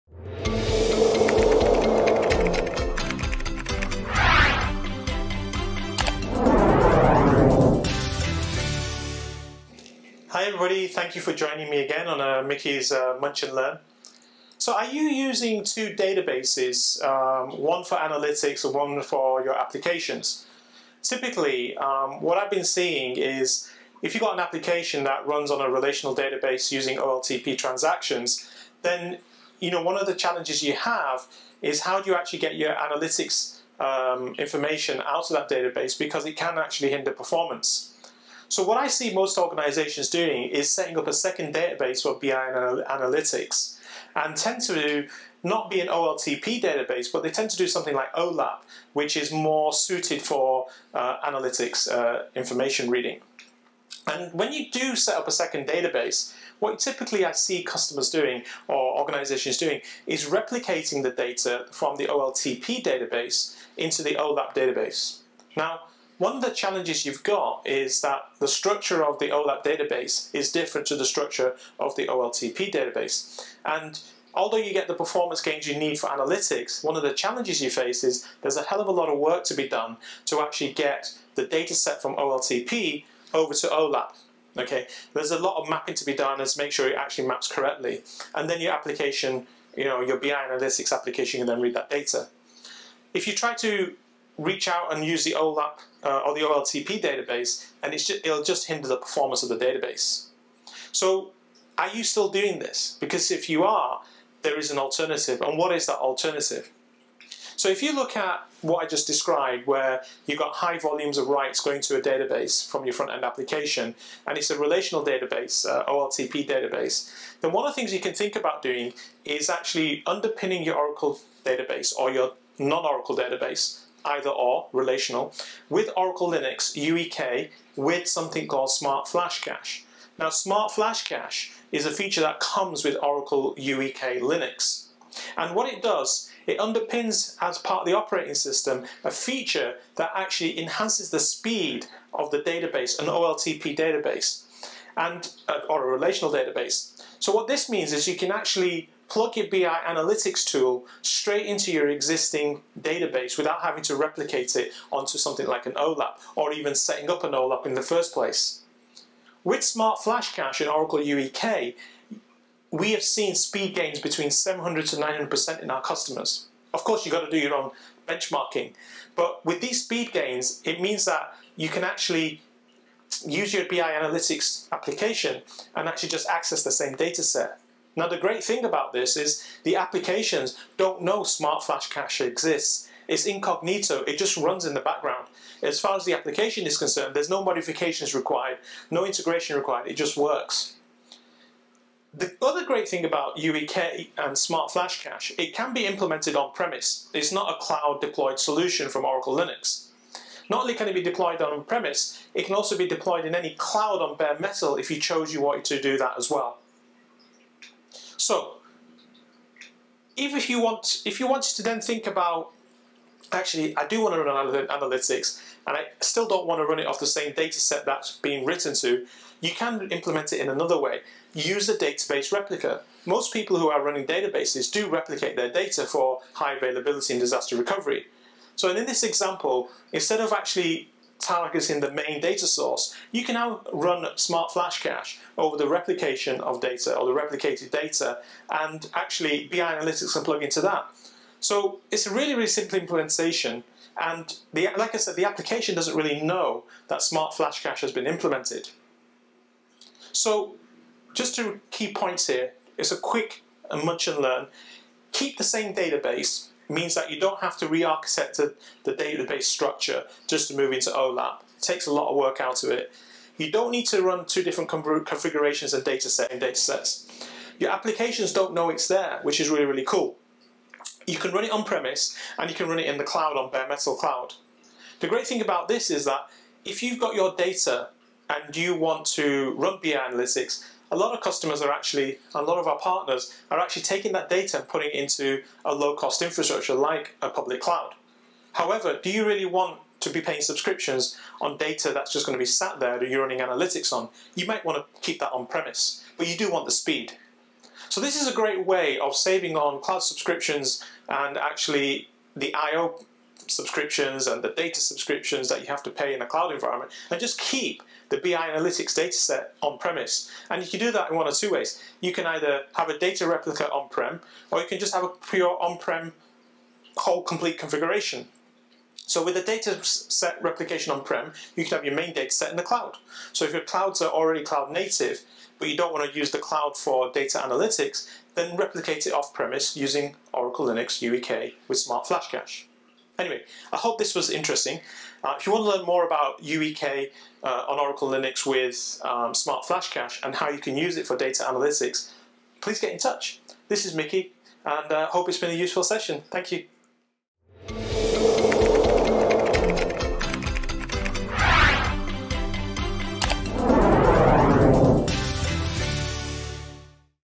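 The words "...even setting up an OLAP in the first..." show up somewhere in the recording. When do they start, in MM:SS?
02:36.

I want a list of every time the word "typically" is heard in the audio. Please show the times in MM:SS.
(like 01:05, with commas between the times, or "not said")
00:21, 00:56.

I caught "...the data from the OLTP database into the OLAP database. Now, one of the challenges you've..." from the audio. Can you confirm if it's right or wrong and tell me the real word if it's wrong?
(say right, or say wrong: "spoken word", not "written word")
right.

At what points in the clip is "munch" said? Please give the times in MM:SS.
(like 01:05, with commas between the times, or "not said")
00:13, 04:13.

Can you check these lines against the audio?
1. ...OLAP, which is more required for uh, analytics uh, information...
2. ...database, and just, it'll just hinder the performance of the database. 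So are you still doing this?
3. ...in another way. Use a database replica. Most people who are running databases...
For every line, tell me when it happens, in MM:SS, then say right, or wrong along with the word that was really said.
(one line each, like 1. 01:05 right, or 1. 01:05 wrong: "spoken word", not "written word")
1. 00:48 wrong: "suited", not "required"
2. 01:37 right
3. 03:40 right.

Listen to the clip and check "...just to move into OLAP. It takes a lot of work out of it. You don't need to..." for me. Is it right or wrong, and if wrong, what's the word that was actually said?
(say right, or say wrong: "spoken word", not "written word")
right.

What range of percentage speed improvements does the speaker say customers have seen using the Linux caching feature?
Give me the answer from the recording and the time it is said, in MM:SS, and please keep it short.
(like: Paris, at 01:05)
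700 to 900%, at 02:44.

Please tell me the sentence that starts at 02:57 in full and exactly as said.
Now the great thing about this is the applications don't know Smart Flash Cache exists.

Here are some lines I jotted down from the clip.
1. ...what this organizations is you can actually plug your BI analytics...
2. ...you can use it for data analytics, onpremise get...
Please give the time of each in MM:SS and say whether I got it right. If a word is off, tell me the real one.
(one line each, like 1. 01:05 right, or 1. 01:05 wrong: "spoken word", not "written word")
1. 02:27 wrong: "means", not "organizations"
2. 05:40 wrong: "please", not "onpremise".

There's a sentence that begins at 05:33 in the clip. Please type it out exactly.
Anyway, I hope this was interesting.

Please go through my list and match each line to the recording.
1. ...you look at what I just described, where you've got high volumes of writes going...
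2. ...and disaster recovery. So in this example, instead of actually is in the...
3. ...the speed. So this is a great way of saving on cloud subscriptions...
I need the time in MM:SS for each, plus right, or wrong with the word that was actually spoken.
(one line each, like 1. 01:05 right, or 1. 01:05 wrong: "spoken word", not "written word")
1. 01:47 right
2. 03:47 right
3. 04:56 right.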